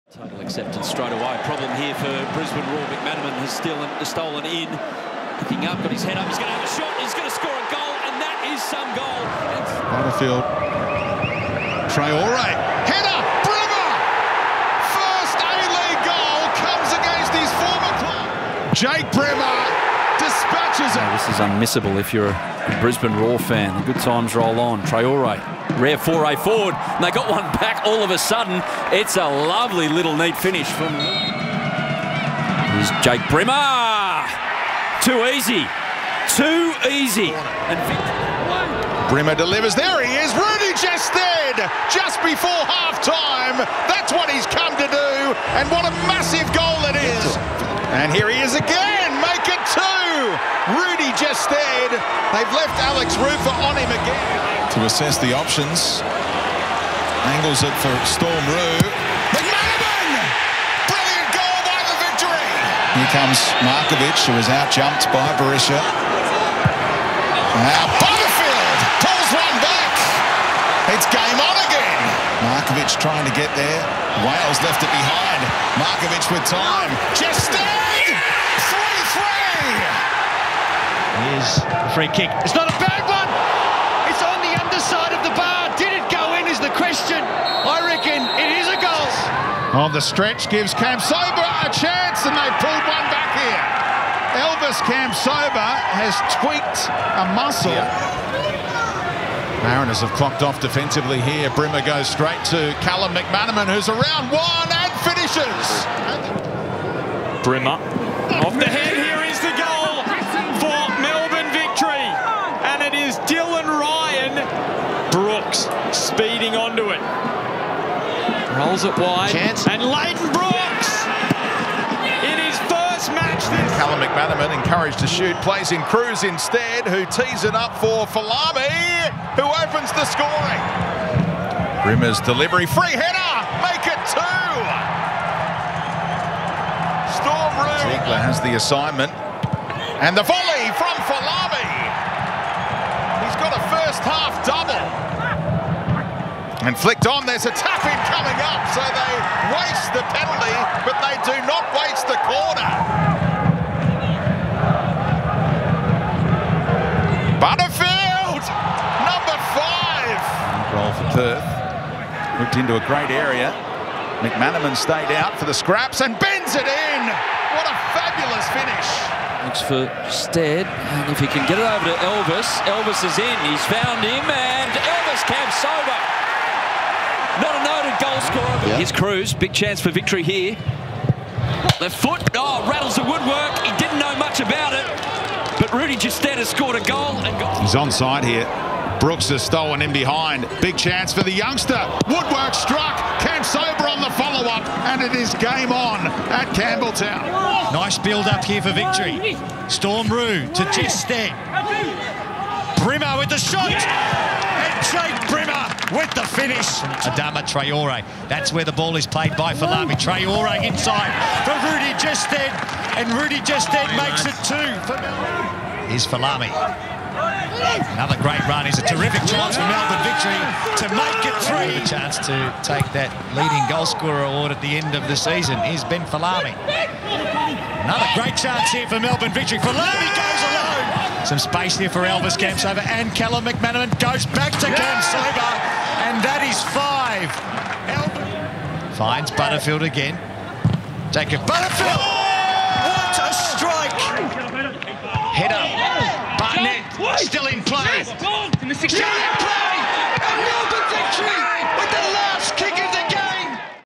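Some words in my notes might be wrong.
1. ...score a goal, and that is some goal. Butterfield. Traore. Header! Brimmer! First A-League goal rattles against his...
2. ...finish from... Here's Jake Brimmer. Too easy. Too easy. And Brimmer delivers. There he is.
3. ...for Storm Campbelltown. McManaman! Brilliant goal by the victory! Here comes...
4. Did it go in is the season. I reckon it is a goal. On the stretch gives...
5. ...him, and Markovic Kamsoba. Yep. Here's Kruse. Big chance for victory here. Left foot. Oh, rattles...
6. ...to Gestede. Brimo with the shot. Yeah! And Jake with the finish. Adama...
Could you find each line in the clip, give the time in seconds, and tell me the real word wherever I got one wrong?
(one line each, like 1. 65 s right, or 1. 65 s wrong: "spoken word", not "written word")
1. 7 s wrong: "comes", not "rattles"
2. 30 s right
3. 57 s wrong: "Roux", not "Campbelltown"
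4. 85 s wrong: "question", not "season"
5. 174 s wrong: "Elvis", not "Markovic"
6. 200 s right.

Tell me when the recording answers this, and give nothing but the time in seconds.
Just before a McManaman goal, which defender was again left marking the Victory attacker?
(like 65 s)
52 s.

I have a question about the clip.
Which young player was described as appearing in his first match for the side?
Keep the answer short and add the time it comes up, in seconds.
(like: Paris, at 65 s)
Lleyton Brooks, at 119 s.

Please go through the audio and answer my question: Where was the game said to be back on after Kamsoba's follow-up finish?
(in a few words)
Campbelltown.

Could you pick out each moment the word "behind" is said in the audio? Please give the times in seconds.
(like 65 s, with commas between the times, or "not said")
74 s, 189 s.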